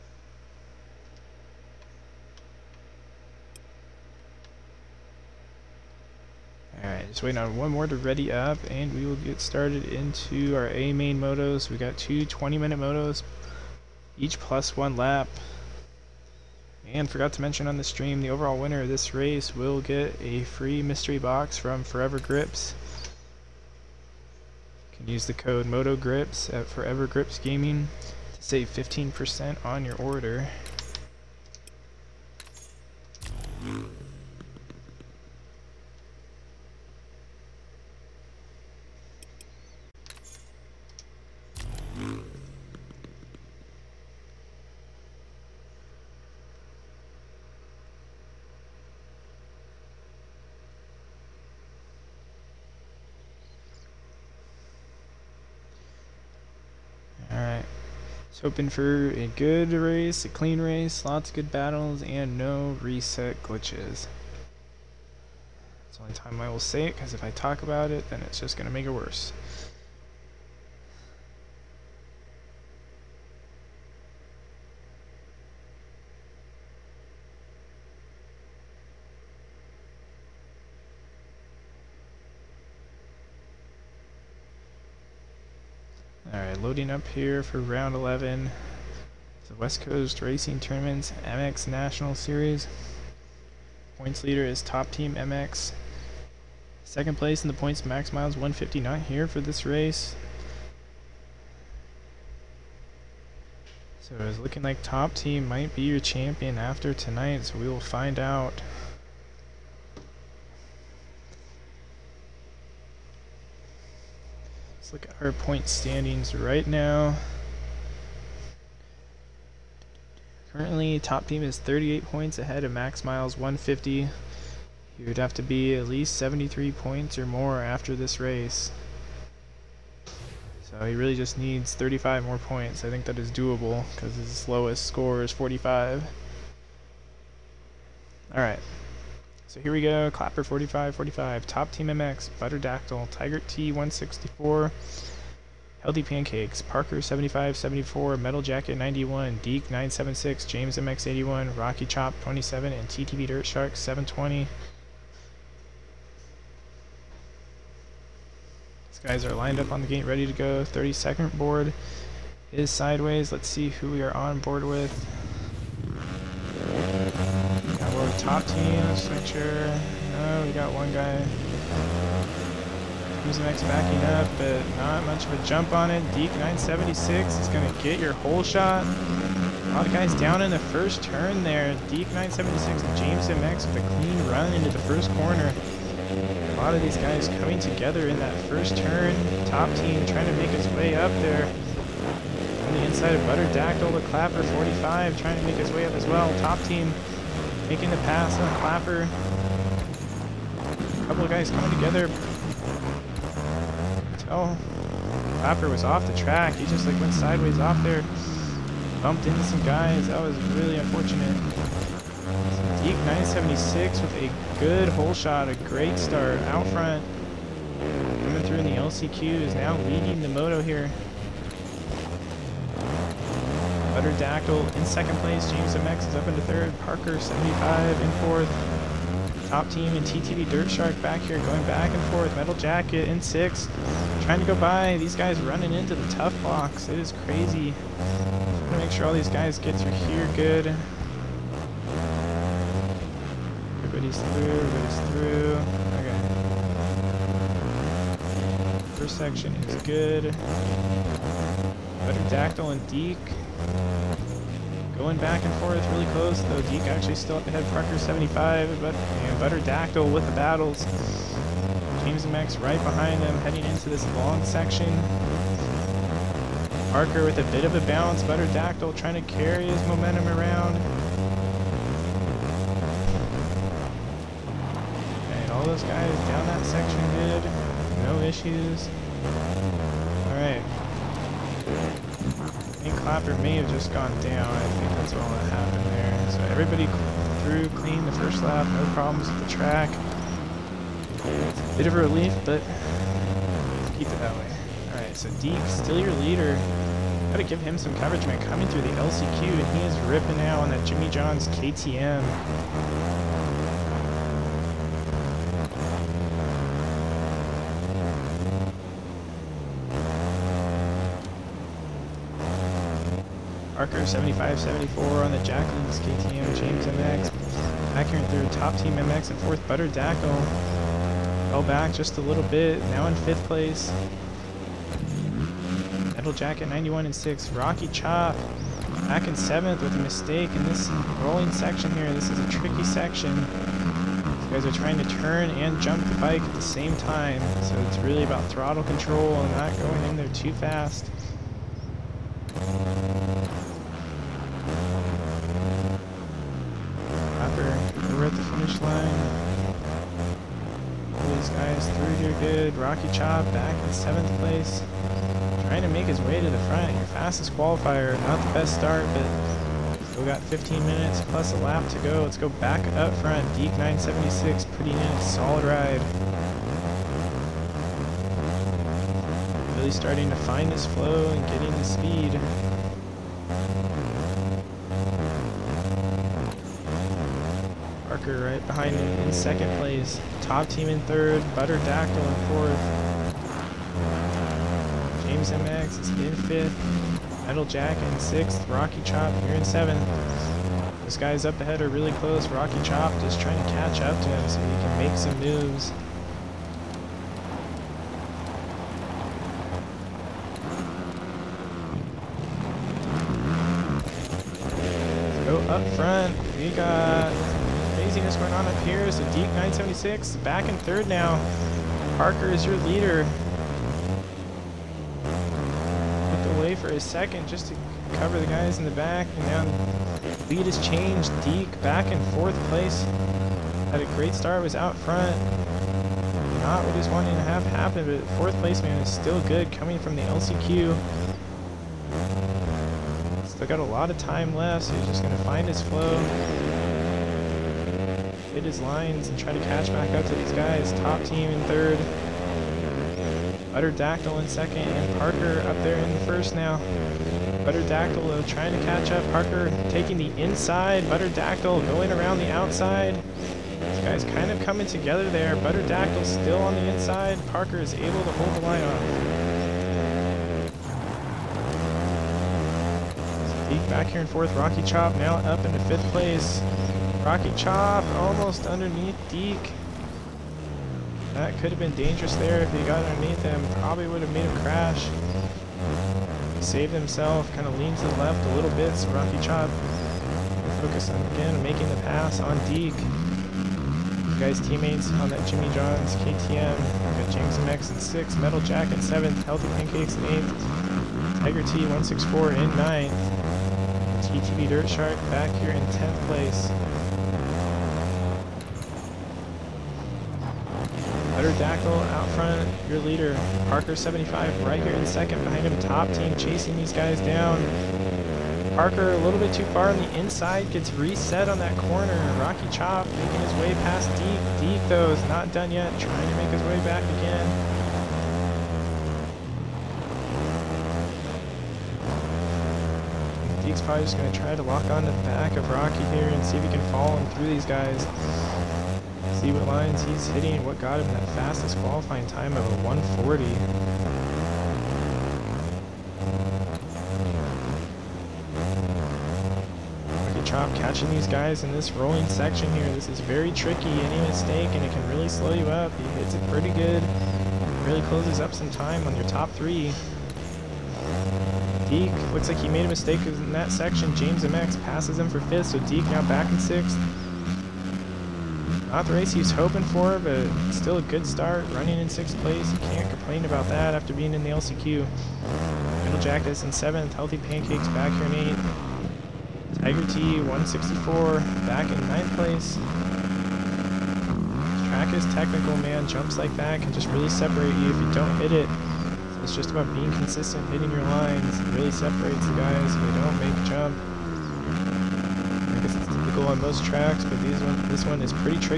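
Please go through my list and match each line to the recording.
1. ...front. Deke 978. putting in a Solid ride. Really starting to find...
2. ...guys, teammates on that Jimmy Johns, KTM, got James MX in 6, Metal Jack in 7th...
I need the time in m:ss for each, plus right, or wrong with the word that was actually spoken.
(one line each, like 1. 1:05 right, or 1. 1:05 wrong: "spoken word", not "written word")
1. 6:03 wrong: "976", not "978"
2. 8:04 right.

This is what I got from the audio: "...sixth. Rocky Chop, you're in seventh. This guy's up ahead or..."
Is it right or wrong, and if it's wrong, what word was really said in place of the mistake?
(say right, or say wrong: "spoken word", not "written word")
right.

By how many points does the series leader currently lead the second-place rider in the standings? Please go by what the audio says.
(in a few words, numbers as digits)
38.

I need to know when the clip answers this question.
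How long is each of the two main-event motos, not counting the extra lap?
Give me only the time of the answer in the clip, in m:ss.
0:12.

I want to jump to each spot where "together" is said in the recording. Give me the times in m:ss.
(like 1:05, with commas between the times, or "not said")
3:07, 3:21, 7:34.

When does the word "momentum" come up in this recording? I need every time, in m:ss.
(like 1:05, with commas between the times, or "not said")
4:29.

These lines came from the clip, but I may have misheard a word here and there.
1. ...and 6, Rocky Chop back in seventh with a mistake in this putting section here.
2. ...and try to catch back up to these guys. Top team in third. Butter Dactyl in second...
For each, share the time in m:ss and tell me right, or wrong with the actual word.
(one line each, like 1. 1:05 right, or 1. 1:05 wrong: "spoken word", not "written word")
1. 5:27 wrong: "rolling", not "putting"
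2. 7:19 right.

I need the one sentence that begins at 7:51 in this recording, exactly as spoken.
That could have been dangerous there if he got underneath him.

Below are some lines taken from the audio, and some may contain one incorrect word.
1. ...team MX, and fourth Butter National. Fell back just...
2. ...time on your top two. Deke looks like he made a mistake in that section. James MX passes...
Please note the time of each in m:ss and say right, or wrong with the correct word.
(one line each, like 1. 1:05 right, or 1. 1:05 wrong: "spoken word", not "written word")
1. 5:18 wrong: "Dactyl", not "National"
2. 9:08 wrong: "three", not "two".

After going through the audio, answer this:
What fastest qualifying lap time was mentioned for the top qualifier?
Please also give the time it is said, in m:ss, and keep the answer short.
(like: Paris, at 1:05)
140, at 8:52.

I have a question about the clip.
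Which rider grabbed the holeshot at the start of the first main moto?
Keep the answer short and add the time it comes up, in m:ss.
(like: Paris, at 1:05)
Deke 976, at 2:56.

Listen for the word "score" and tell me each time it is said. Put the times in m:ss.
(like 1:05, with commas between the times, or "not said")
2:14.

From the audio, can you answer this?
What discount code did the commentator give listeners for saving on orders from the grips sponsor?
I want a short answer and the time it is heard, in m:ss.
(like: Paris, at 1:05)
MOTOGRIPS, at 0:25.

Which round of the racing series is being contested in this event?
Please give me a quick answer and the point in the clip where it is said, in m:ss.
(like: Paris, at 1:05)
11, at 1:27.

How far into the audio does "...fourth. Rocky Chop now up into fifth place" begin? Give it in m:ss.
7:44.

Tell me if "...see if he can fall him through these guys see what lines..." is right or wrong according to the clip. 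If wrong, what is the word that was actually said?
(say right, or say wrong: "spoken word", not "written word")
right.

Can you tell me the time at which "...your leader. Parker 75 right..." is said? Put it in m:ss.
8:22.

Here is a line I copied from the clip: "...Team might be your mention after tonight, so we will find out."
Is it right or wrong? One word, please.
wrong.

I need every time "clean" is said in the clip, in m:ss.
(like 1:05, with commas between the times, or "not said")
1:00, 3:03, 4:47.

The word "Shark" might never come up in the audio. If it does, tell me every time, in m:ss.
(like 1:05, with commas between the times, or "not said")
2:33, 3:50, 8:14.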